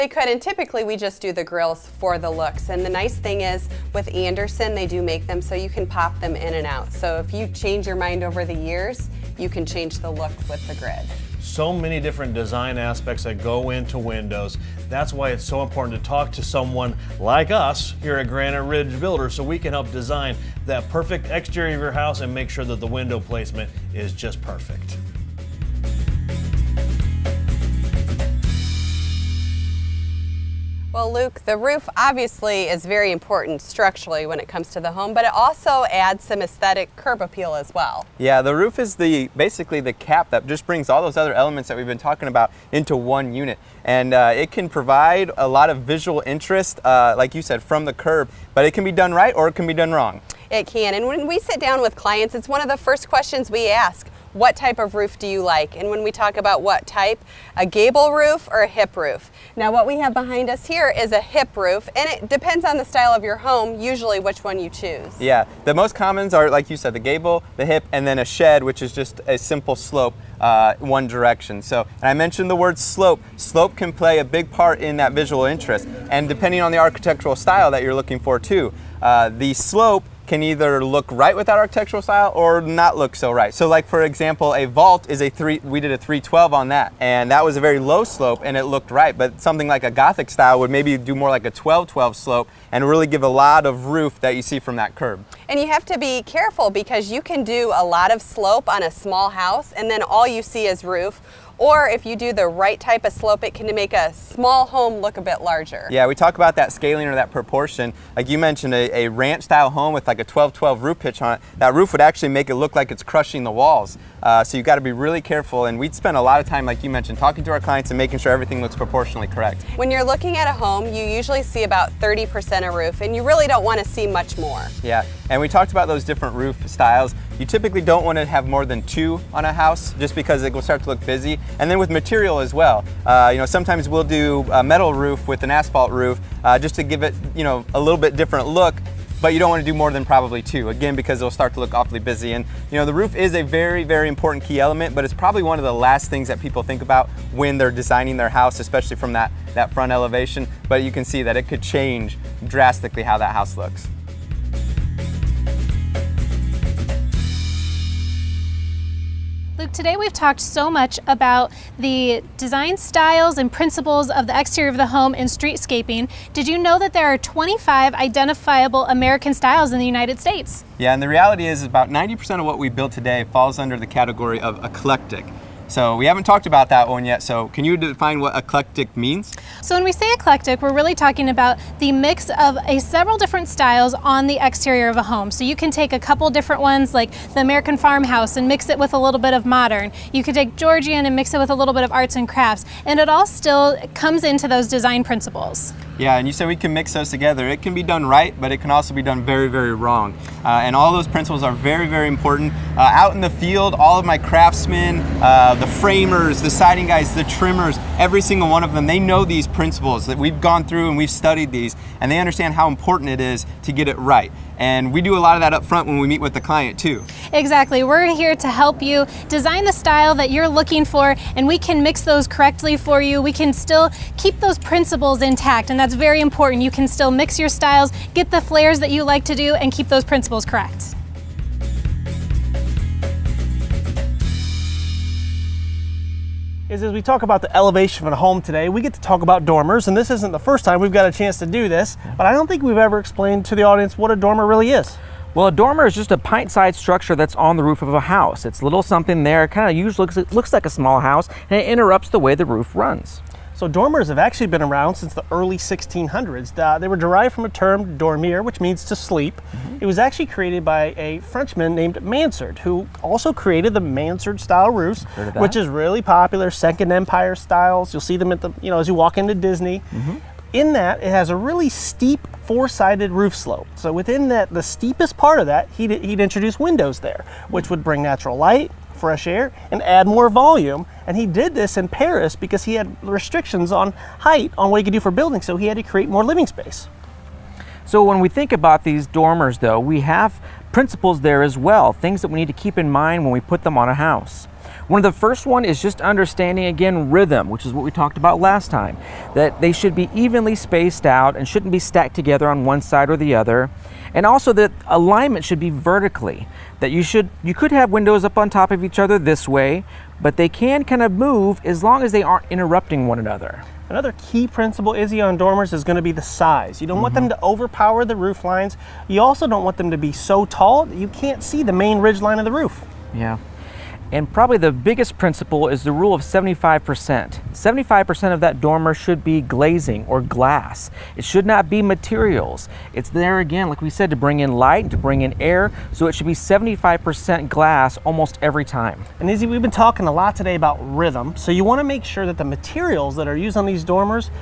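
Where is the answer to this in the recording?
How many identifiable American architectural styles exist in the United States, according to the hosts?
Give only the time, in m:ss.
2:47.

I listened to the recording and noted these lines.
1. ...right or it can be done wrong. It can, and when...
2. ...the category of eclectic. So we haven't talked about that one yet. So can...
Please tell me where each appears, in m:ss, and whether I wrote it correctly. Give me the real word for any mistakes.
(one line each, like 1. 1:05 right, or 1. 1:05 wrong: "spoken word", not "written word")
1. 0:49 right
2. 2:53 right.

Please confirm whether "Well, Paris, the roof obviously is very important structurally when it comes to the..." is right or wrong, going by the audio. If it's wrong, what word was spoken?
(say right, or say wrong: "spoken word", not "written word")
wrong: "Luke", not "Paris".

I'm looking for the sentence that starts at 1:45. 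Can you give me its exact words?
Yeah, we talk about that scaling or that proportion.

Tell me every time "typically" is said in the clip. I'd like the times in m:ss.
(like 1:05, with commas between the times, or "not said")
0:00, 2:07.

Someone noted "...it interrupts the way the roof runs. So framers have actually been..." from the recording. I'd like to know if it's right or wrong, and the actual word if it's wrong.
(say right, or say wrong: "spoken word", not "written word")
wrong: "dormers", not "framers".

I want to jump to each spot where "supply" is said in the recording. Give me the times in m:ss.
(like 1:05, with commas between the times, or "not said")
not said.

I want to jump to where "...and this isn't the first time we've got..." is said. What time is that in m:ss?
3:59.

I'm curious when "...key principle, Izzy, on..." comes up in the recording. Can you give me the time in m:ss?
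5:14.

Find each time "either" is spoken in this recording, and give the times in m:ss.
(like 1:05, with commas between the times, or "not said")
1:20.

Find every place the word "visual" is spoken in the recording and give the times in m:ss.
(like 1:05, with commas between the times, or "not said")
0:45, 1:15.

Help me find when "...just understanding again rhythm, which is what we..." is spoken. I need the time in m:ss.
4:55.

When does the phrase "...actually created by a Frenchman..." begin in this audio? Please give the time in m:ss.
4:20.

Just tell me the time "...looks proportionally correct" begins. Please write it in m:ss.
1:58.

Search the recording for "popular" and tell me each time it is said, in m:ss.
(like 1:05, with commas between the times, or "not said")
4:26.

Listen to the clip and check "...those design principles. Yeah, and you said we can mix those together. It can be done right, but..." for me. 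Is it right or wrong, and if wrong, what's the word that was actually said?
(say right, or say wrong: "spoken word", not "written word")
right.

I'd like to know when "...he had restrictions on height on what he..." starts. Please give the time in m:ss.
4:42.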